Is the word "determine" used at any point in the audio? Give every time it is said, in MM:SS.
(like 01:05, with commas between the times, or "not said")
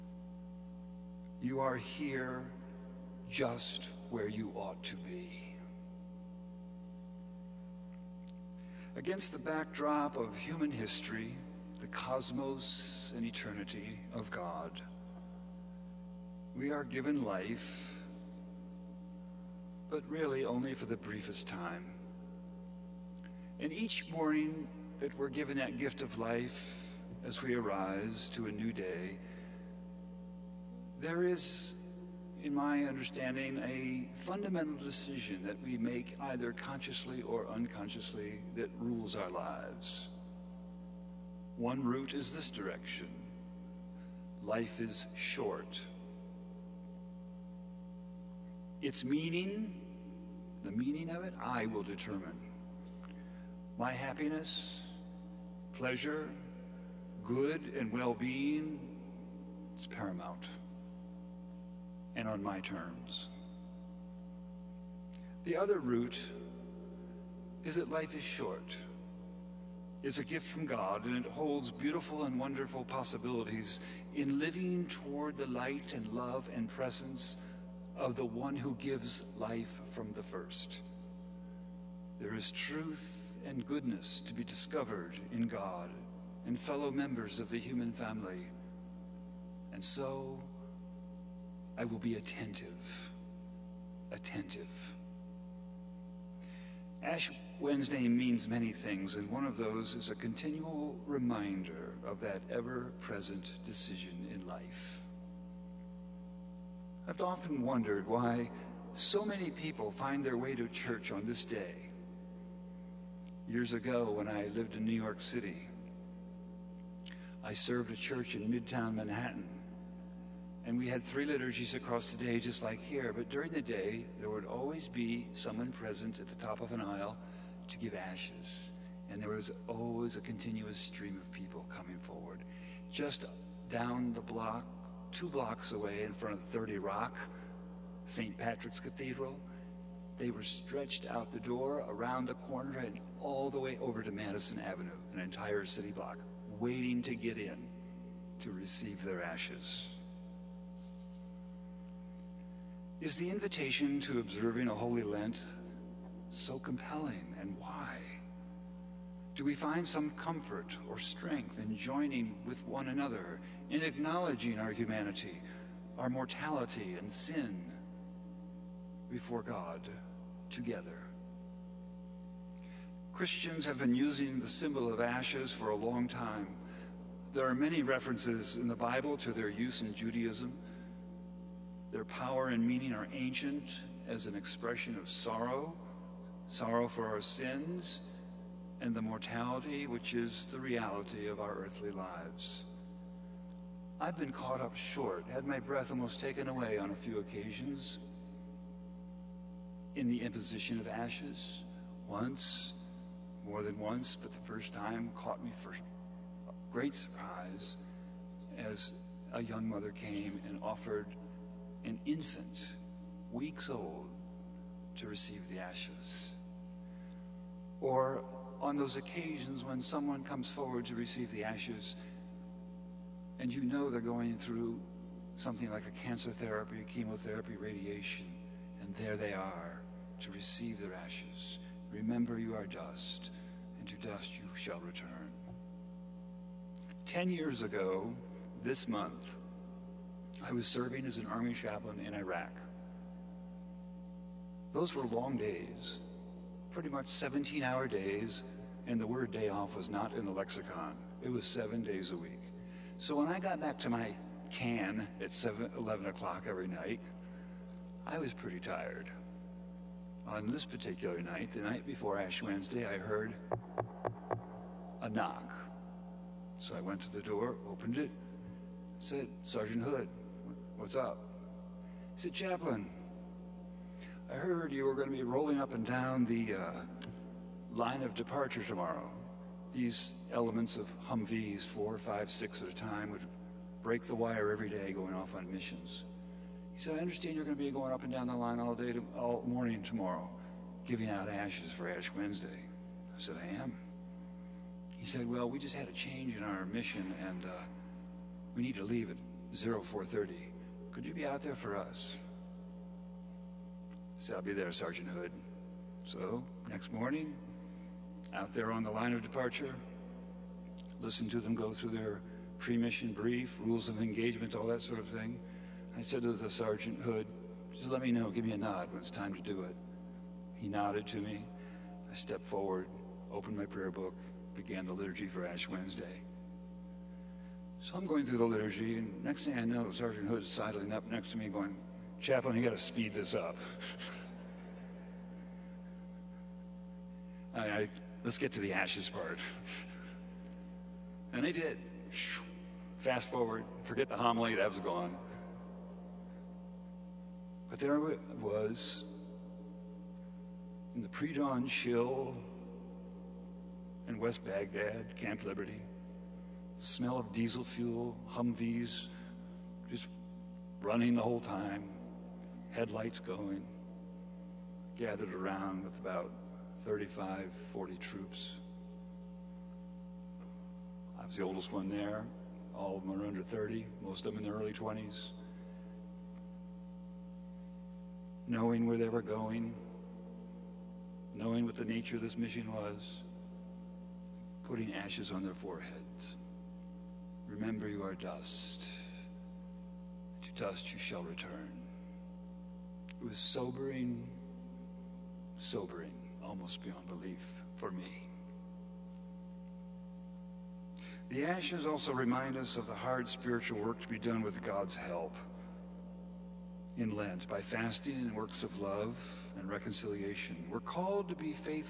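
00:51.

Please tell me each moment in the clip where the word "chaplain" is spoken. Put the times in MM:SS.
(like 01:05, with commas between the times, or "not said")
04:01, 04:32, 05:32.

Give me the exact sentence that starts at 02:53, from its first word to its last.
Christians have been using the symbol of ashes for a long time.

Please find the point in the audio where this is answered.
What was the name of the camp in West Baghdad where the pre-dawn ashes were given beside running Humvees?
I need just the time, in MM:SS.
05:55.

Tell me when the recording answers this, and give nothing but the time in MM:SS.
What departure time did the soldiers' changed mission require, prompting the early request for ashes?
04:59.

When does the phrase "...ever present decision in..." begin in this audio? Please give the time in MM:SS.
01:42.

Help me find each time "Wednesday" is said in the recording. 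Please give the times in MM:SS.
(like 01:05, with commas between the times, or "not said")
01:37, 04:22, 04:52, 05:25.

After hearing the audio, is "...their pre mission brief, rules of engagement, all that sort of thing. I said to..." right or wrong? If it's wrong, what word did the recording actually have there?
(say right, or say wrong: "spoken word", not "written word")
right.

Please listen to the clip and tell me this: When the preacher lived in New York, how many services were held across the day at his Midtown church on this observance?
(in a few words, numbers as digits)
3.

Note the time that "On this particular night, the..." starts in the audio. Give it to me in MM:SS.
04:20.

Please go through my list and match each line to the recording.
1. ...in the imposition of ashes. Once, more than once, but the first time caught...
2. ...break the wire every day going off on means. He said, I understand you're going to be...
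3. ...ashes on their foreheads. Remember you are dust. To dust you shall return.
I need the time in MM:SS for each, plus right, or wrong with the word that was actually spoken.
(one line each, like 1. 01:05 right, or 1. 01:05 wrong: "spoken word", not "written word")
1. 03:19 right
2. 04:43 wrong: "missions", not "means"
3. 06:24 right.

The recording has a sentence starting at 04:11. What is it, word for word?
It was seven days a week.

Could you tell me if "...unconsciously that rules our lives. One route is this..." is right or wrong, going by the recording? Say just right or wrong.
right.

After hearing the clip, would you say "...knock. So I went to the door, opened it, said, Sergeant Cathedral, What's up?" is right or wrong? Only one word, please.
wrong.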